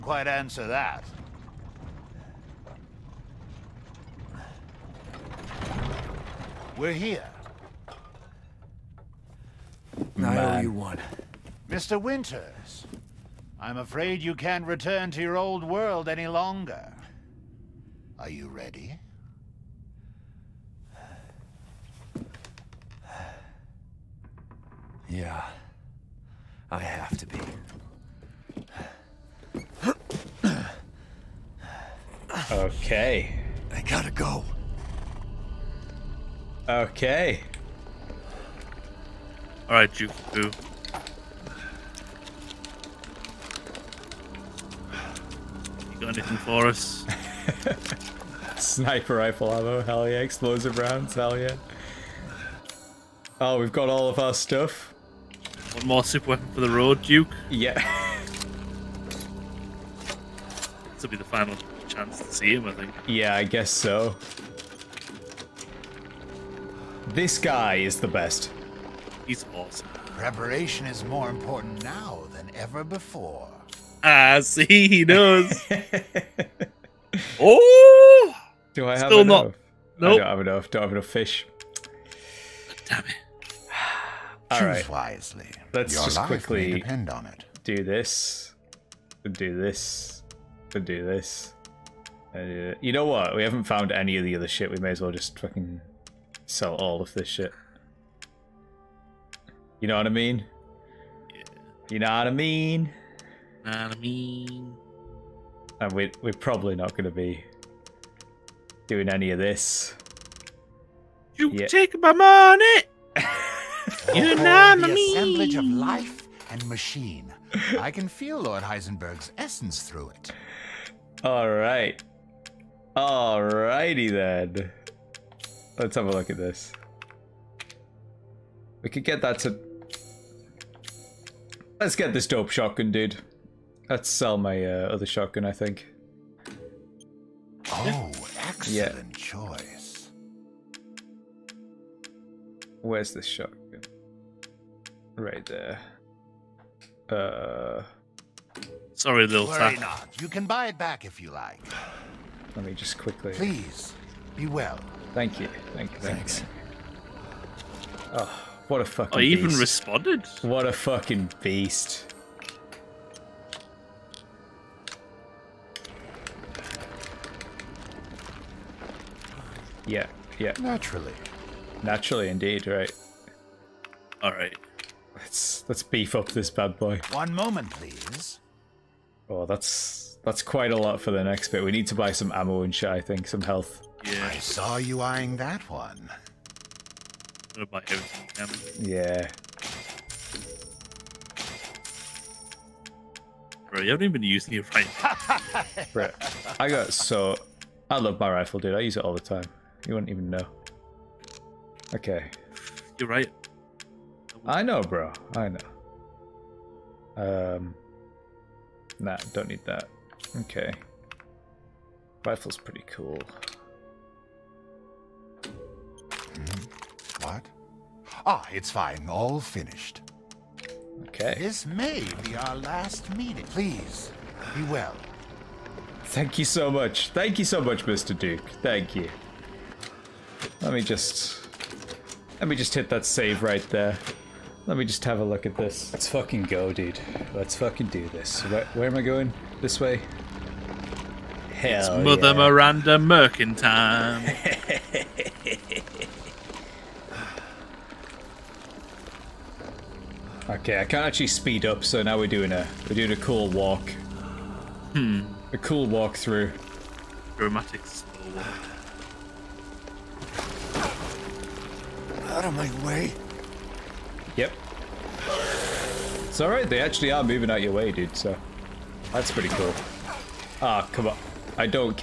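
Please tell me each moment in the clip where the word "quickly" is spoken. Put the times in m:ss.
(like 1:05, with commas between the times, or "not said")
1:26, 2:32.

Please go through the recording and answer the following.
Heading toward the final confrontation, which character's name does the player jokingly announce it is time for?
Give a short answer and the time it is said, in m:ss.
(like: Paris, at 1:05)
Mother Miranda, at 4:02.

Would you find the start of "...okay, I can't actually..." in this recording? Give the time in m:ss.
4:10.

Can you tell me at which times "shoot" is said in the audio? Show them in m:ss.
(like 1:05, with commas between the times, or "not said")
not said.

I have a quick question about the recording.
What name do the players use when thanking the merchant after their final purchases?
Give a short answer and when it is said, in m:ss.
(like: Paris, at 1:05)
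Mr. Duke, at 3:47.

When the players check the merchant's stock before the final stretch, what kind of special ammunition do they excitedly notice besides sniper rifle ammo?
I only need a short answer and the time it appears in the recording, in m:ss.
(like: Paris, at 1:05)
Explosive rounds, at 0:50.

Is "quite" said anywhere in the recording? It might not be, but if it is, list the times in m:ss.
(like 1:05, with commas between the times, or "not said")
0:00, 3:00.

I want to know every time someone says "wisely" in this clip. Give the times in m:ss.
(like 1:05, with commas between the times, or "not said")
1:24.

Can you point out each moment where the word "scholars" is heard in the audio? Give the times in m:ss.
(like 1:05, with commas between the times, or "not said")
not said.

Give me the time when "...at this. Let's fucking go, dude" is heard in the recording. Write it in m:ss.
3:55.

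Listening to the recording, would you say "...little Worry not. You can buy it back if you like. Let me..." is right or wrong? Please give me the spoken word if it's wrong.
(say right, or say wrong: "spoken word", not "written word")
right.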